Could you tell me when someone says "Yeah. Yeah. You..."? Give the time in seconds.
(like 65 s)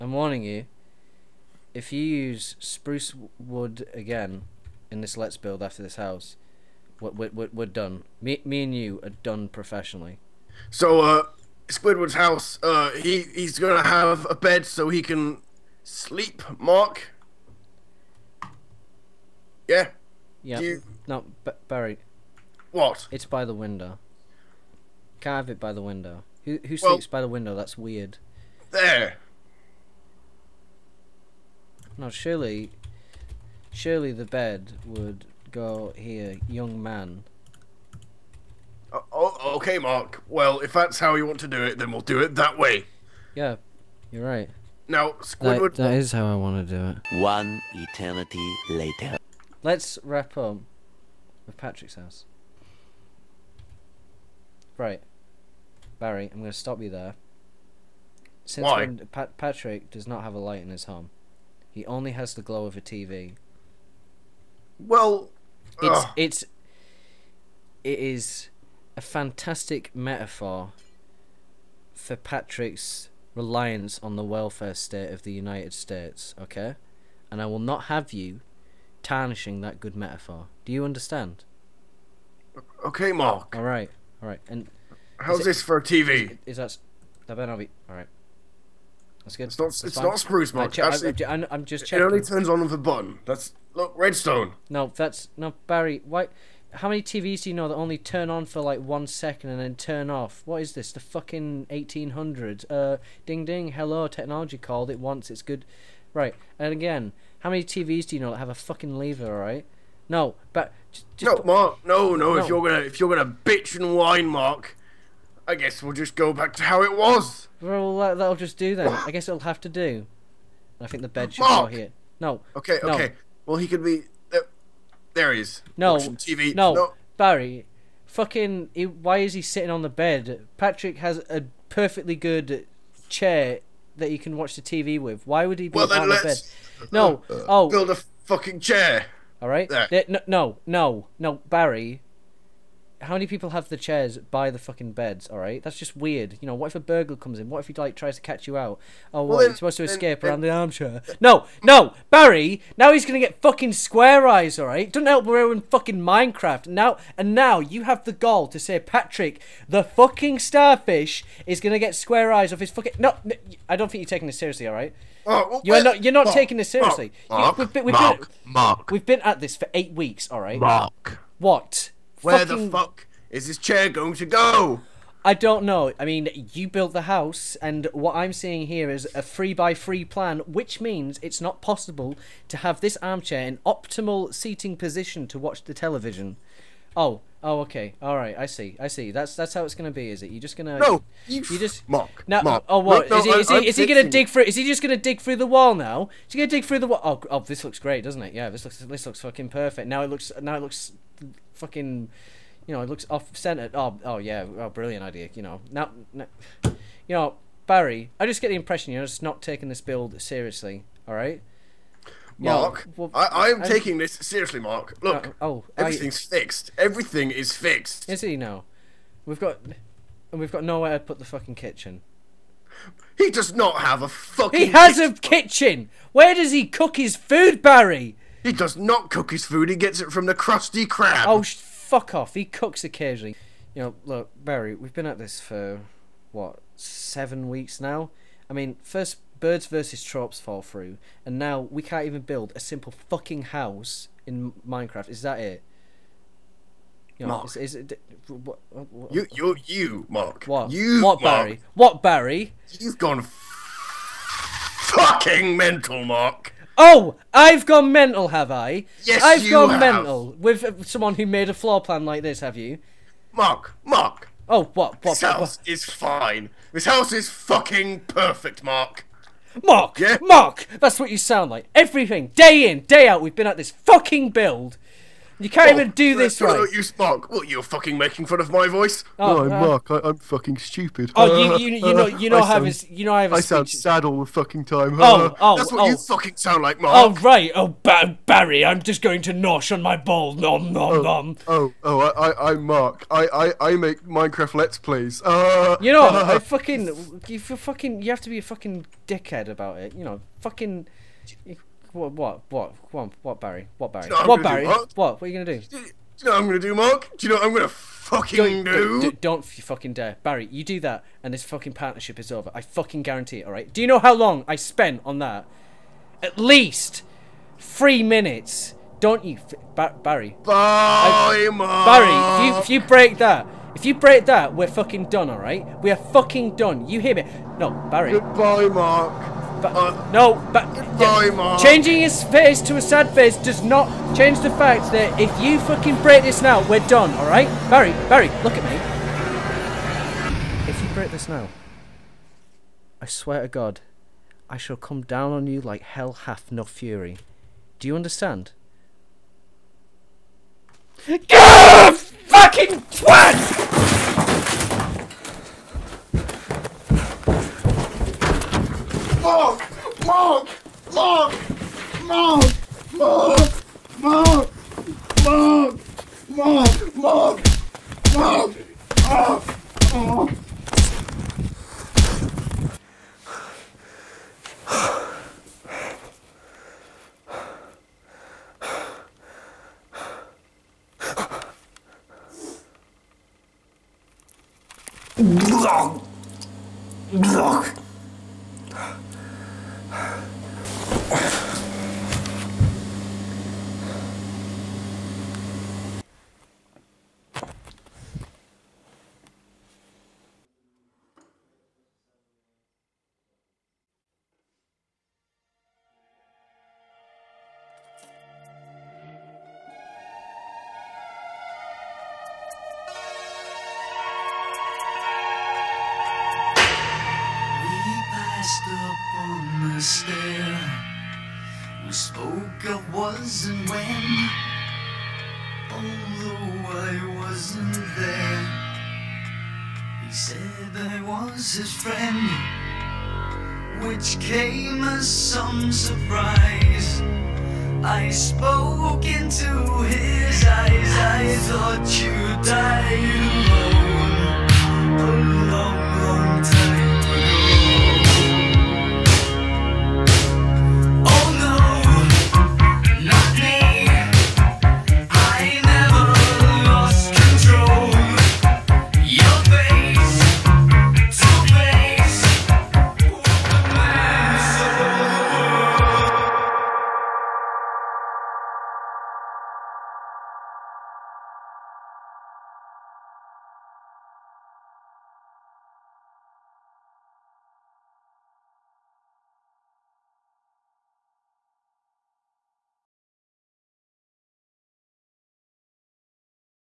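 19 s.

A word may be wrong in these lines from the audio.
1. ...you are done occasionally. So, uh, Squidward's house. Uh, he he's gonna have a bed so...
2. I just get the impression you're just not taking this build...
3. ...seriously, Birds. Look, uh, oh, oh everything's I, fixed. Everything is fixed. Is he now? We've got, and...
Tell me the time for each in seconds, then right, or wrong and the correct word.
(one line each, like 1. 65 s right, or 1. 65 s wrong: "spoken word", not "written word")
1. 8 s wrong: "professionally", not "occasionally"
2. 208 s right
3. 214 s wrong: "Mark", not "Birds".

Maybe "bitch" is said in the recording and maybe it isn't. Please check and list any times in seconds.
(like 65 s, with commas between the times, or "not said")
113 s.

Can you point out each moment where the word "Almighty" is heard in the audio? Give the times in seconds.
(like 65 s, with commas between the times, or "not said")
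not said.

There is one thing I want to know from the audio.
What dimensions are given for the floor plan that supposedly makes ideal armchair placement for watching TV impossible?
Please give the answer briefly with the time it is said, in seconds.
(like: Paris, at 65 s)
3 by 3, at 179 s.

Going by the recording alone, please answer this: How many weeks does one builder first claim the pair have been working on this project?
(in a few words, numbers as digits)
8.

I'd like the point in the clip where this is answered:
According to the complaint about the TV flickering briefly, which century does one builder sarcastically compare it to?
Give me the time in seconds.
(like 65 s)
101 s.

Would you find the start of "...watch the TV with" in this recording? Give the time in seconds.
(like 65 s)
134 s.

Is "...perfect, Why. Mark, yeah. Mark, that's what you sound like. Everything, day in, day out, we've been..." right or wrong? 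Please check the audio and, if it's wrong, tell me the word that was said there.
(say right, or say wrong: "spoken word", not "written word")
wrong: "Mark", not "Why".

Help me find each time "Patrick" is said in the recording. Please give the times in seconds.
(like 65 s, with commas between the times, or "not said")
51 s, 59 s, 72 s, 130 s, 158 s.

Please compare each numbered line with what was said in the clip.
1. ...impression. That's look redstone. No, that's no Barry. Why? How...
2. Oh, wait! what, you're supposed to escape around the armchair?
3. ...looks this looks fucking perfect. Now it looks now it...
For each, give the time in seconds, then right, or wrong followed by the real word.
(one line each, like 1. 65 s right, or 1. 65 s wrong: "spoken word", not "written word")
1. 92 s wrong: "button", not "impression"
2. 149 s right
3. 198 s right.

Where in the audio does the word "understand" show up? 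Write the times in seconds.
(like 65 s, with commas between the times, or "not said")
80 s, 347 s.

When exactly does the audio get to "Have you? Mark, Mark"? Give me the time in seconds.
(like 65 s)
262 s.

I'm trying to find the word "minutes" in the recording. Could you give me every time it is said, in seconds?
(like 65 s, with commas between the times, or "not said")
318 s.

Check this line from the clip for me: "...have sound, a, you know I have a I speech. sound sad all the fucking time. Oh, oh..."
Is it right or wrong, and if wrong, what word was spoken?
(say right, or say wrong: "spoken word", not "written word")
right.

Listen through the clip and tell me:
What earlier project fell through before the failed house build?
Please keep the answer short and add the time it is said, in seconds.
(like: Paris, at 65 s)
Birds versus tropes, at 239 s.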